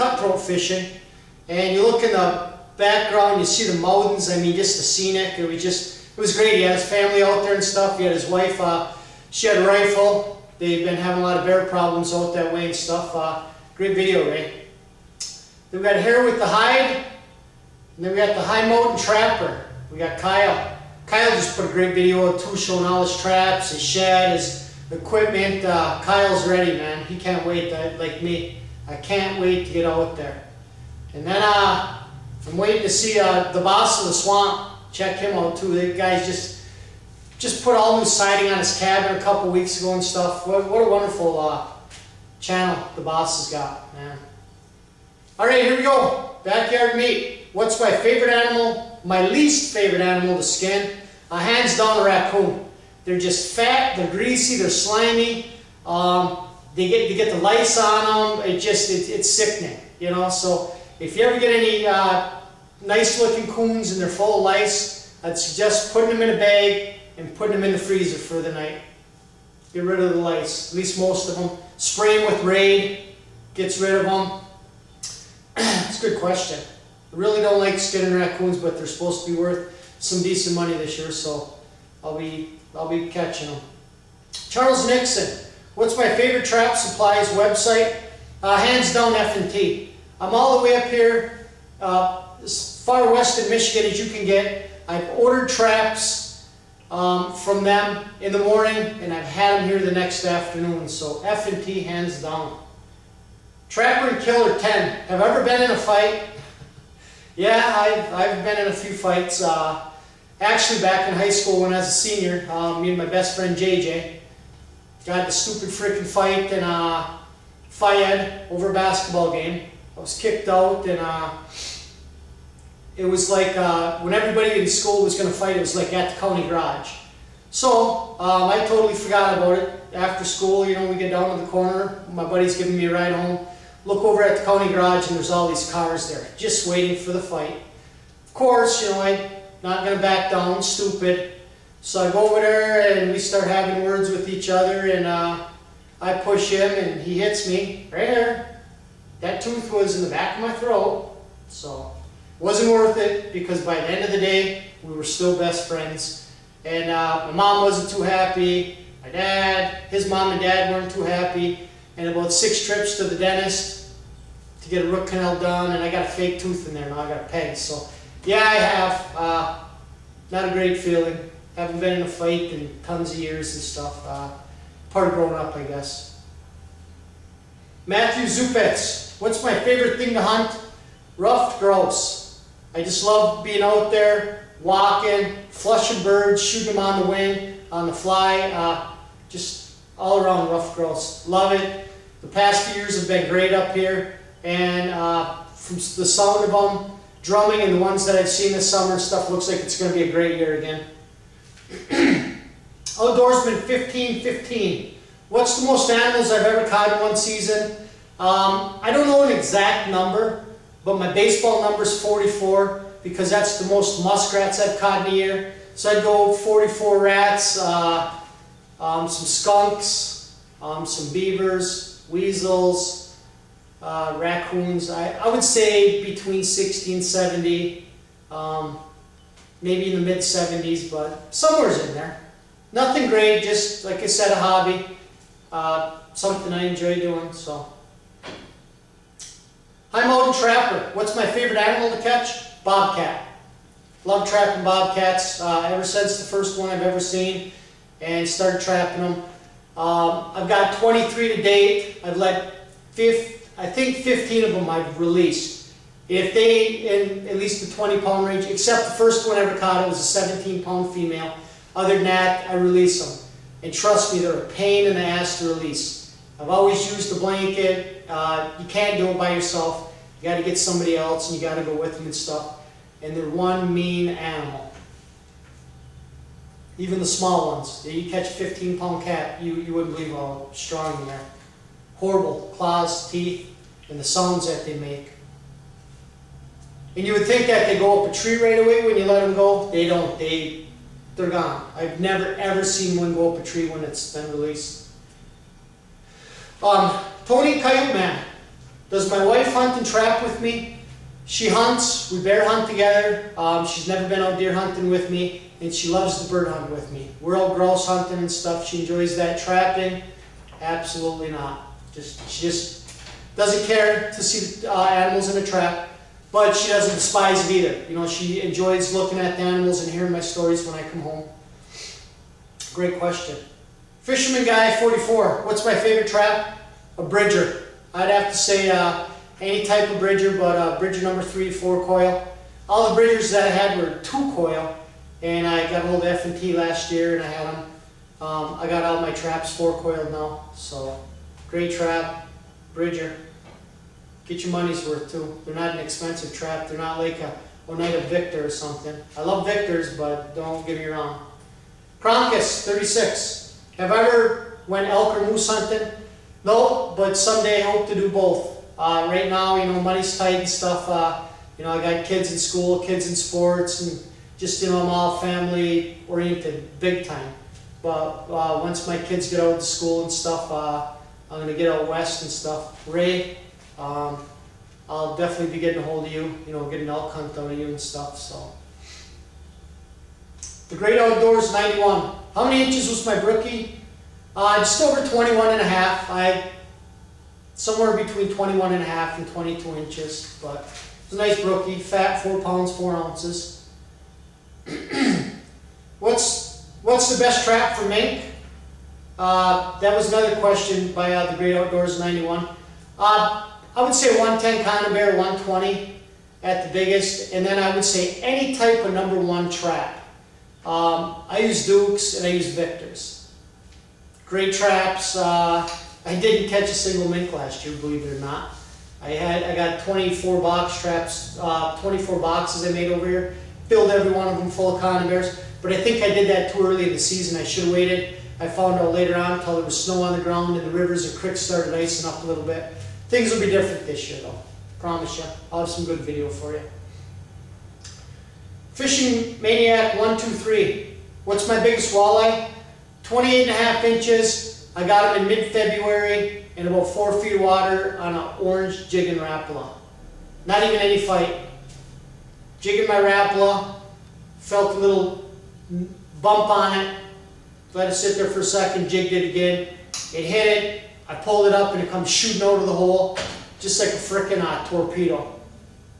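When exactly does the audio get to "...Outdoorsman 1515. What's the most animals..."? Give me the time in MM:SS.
03:22.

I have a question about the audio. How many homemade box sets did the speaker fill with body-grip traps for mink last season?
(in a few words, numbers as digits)
24.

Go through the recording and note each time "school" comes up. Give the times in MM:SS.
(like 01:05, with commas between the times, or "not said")
01:51, 02:04, 02:10, 06:02, 06:09.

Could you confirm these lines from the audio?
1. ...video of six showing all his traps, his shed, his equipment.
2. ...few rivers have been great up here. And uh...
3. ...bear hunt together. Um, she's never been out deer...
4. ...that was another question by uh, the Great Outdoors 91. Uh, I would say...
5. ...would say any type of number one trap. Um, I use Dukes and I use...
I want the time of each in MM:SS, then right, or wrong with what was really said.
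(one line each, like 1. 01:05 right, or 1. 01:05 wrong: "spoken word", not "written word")
1. 00:21 wrong: "two", not "six"
2. 03:12 wrong: "years", not "rivers"
3. 05:02 right
4. 06:39 right
5. 06:47 right.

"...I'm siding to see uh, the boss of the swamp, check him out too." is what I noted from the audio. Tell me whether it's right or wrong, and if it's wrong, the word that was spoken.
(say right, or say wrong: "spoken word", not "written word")
wrong: "waiting", not "siding".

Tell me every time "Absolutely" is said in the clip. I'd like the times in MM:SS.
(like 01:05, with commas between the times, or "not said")
05:10.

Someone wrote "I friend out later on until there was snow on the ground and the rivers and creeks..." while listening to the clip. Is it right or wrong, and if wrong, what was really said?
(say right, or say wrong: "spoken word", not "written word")
wrong: "found", not "friend".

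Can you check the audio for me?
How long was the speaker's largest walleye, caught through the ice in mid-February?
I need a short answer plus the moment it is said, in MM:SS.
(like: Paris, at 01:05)
28.5 inches, at 07:23.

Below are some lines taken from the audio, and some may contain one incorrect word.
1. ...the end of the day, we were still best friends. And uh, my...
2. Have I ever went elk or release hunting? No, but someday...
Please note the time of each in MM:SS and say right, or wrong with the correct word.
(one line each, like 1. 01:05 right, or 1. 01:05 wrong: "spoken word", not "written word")
1. 02:33 right
2. 05:53 wrong: "moose", not "release".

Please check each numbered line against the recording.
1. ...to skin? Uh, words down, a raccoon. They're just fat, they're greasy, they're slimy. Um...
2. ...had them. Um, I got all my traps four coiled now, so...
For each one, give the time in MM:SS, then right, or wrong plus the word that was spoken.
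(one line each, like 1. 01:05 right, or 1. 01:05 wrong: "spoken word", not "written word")
1. 00:50 wrong: "hands", not "words"
2. 05:37 right.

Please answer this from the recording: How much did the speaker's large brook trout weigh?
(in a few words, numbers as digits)
4 pounds, 4 ounces.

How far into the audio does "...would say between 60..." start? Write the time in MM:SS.
03:45.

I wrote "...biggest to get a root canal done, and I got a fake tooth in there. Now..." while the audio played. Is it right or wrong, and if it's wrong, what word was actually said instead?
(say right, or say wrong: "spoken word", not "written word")
wrong: "dentist", not "biggest".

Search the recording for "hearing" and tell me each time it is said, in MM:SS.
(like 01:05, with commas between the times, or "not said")
05:19.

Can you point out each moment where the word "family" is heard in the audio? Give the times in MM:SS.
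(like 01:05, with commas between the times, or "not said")
00:06, 06:05.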